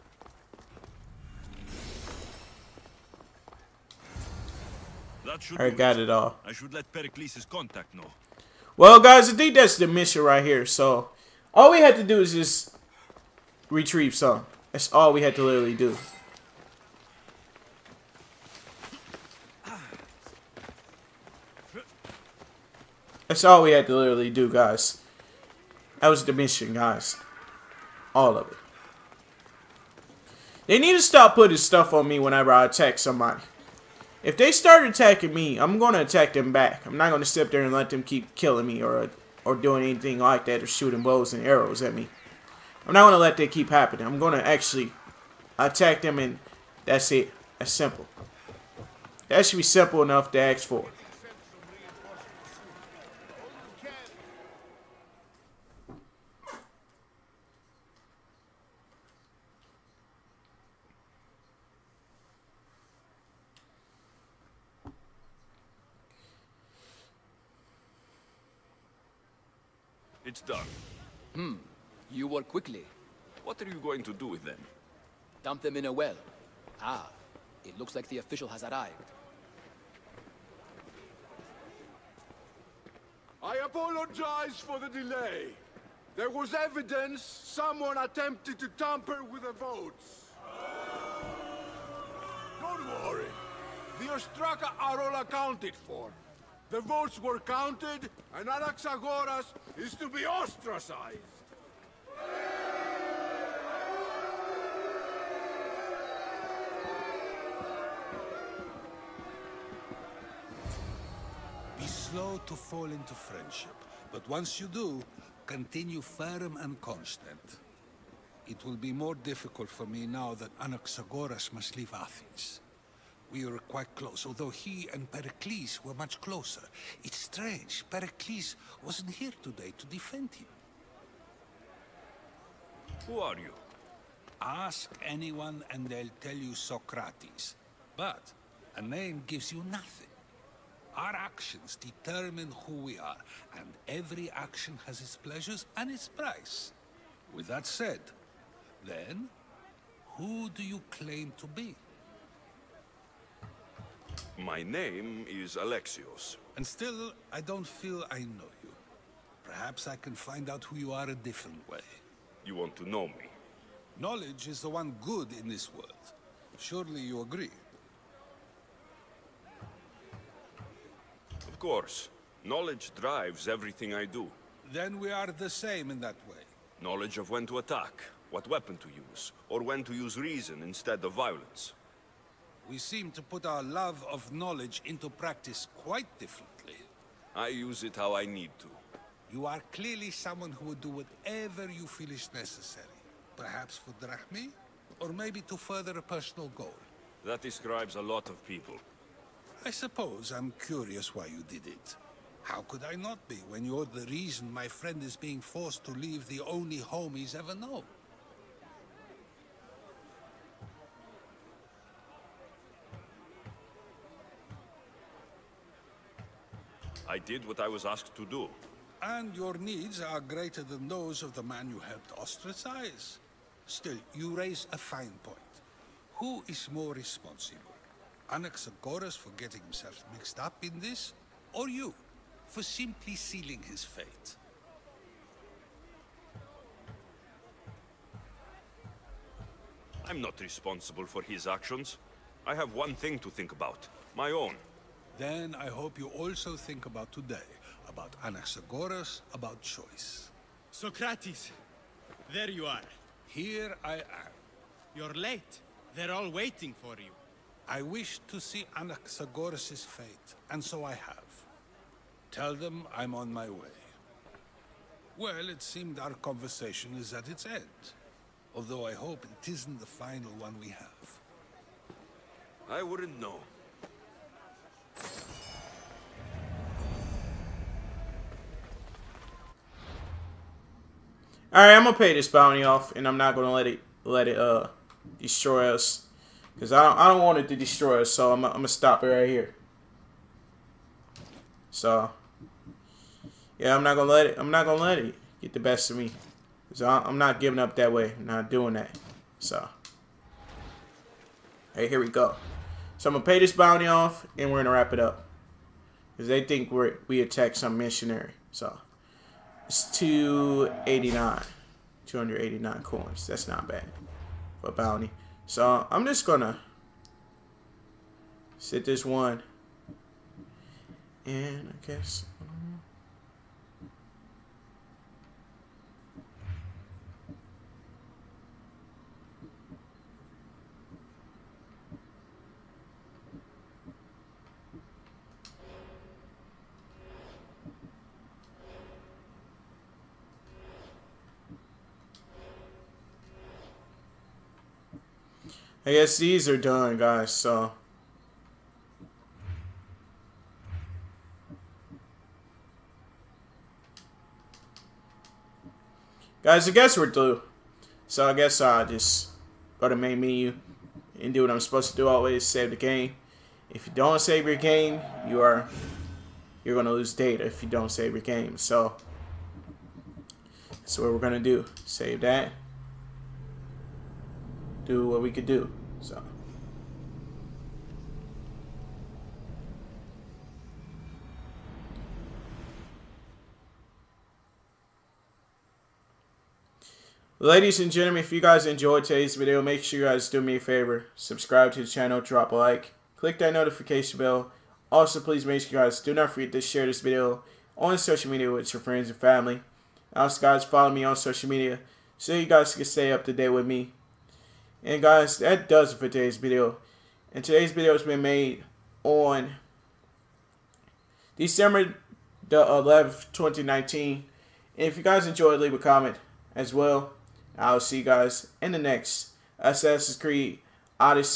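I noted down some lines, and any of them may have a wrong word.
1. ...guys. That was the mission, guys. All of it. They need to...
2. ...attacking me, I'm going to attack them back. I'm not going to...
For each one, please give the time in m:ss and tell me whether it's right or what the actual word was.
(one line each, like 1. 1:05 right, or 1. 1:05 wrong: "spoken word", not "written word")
1. 0:24 right
2. 0:34 right.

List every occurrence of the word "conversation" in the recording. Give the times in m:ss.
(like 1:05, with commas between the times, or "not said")
4:26.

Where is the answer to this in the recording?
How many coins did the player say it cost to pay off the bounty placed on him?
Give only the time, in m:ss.
5:12.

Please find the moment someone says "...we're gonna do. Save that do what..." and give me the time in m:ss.
6:11.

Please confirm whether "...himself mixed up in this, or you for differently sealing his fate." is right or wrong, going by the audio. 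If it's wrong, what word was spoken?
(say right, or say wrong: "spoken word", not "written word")
wrong: "simply", not "differently".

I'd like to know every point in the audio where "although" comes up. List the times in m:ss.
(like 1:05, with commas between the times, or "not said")
2:04, 4:28.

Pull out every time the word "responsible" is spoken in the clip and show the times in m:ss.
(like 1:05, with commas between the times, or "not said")
3:46, 4:00.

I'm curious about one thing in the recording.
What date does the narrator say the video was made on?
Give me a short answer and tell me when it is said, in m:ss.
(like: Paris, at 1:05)
December 11, 2019, at 6:51.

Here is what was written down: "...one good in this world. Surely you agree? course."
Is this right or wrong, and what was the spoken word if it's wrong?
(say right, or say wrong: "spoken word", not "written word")
right.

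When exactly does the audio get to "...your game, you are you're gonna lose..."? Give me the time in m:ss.
6:04.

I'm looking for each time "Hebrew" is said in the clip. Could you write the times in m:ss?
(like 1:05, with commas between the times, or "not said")
not said.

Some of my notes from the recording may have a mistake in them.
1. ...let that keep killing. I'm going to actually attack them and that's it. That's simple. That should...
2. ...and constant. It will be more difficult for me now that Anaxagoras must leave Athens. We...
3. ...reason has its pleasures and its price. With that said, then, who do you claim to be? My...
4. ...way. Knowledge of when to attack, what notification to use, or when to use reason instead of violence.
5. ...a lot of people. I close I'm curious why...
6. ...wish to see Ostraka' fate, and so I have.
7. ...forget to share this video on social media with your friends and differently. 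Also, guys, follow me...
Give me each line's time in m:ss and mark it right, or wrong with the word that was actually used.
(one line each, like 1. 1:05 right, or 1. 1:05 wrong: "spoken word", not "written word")
1. 0:43 wrong: "happening", not "killing"
2. 1:56 right
3. 2:24 wrong: "action", not "reason"
4. 2:56 wrong: "weapon", not "notification"
5. 3:17 wrong: "suppose", not "close"
6. 4:17 wrong: "Anaxagoras", not "Ostraka"
7. 6:36 wrong: "family", not "differently".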